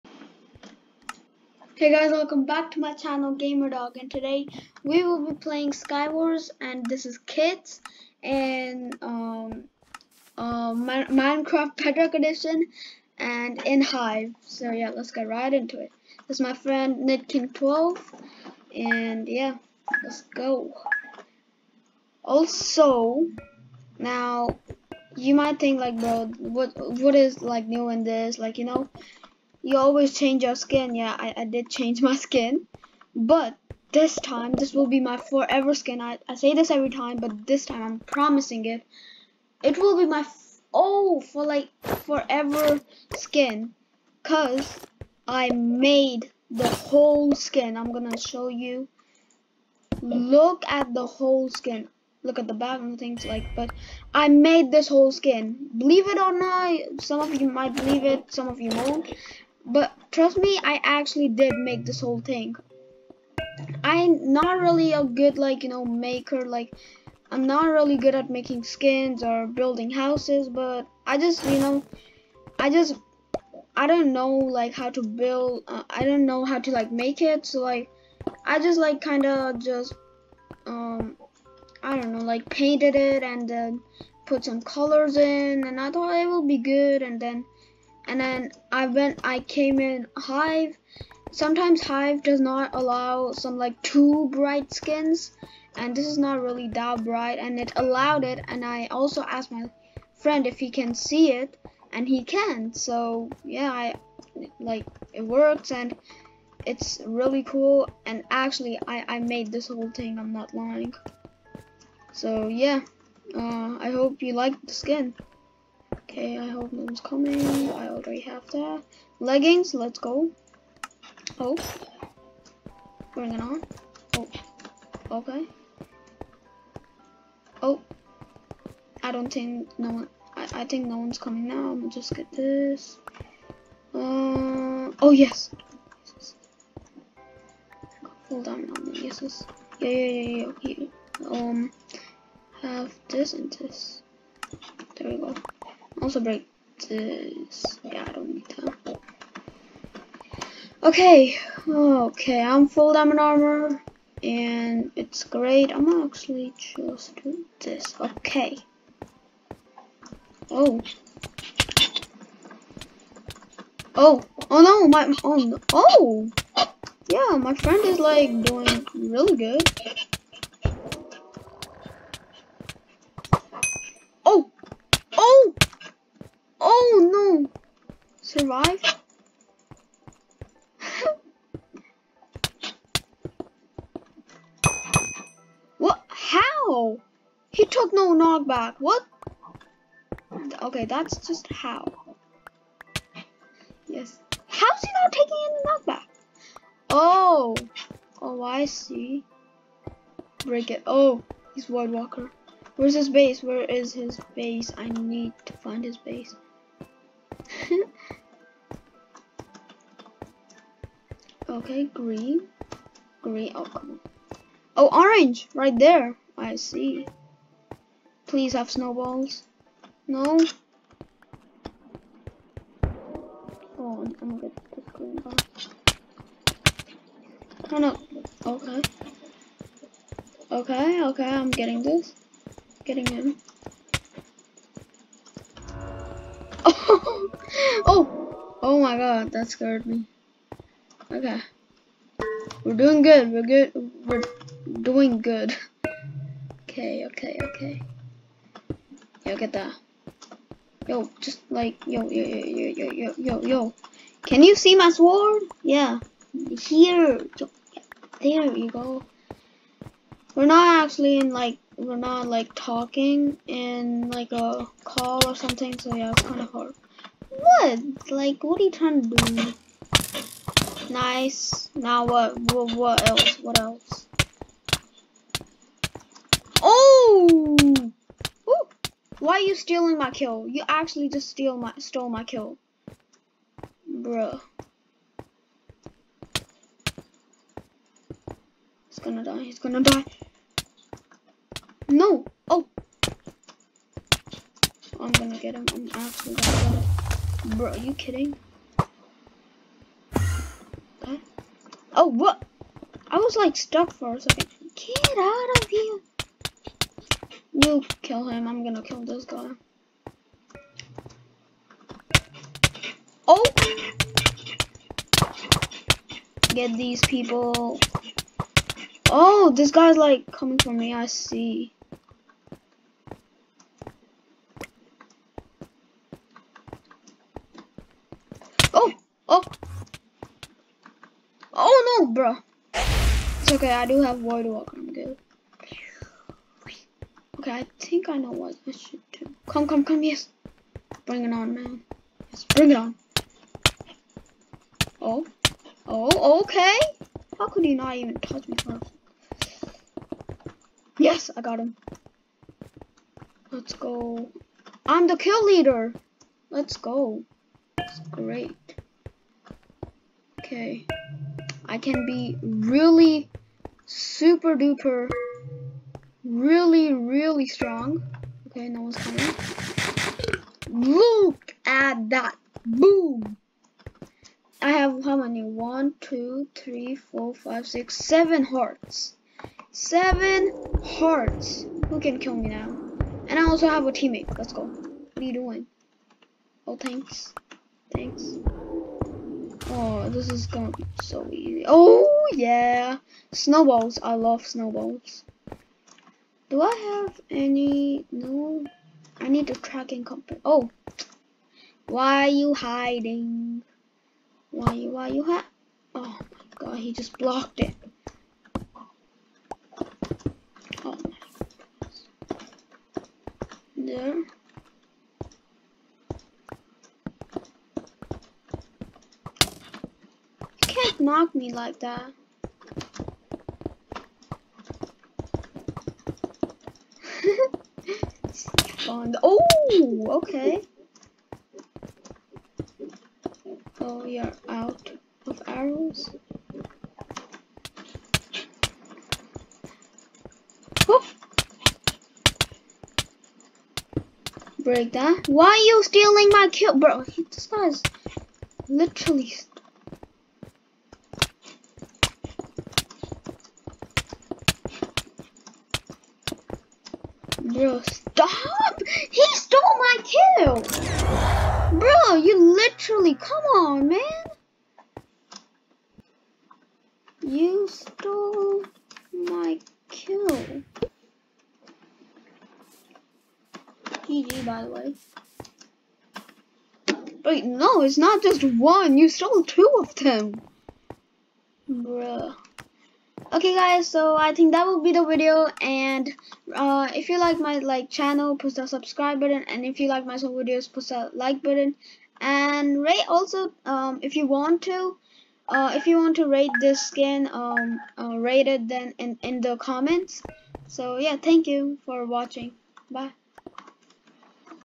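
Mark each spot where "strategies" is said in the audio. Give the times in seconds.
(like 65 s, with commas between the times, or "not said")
not said.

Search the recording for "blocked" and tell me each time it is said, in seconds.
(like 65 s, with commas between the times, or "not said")
407 s.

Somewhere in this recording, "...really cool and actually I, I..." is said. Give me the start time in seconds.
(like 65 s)
107 s.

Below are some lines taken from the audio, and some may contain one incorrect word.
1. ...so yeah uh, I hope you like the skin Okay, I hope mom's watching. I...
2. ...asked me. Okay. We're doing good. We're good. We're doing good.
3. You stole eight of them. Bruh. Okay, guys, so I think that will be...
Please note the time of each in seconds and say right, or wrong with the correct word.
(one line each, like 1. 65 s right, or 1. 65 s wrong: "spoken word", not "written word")
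1. 112 s wrong: "coming", not "watching"
2. 239 s wrong: "scared", not "asked"
3. 478 s wrong: "two", not "eight".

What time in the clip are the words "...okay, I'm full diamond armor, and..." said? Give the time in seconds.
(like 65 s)
151 s.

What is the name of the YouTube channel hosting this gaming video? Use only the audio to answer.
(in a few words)
GamerDog.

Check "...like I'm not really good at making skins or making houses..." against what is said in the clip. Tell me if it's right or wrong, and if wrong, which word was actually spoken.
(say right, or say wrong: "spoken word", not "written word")
wrong: "building", not "making".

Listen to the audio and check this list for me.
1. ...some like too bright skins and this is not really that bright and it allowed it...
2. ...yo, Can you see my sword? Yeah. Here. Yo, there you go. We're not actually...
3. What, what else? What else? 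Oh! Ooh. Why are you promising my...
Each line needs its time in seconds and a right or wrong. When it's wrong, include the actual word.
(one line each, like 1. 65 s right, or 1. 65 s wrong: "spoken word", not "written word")
1. 93 s right
2. 253 s right
3. 272 s wrong: "stealing", not "promising".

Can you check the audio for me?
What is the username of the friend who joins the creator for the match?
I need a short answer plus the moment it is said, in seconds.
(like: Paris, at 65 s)
Nitking12, at 17 s.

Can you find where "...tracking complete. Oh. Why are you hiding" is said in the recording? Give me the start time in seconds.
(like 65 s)
399 s.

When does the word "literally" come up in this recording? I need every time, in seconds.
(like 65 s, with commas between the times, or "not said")
448 s, 462 s.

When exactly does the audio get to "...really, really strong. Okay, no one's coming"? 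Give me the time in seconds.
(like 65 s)
366 s.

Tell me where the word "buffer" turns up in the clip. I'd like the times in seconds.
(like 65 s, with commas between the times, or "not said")
not said.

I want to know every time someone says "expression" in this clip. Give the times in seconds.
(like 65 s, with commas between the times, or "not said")
not said.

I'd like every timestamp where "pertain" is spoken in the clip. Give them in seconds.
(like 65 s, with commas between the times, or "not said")
not said.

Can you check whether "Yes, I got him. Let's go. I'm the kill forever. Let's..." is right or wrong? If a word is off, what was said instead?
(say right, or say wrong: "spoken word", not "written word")
wrong: "leader", not "forever".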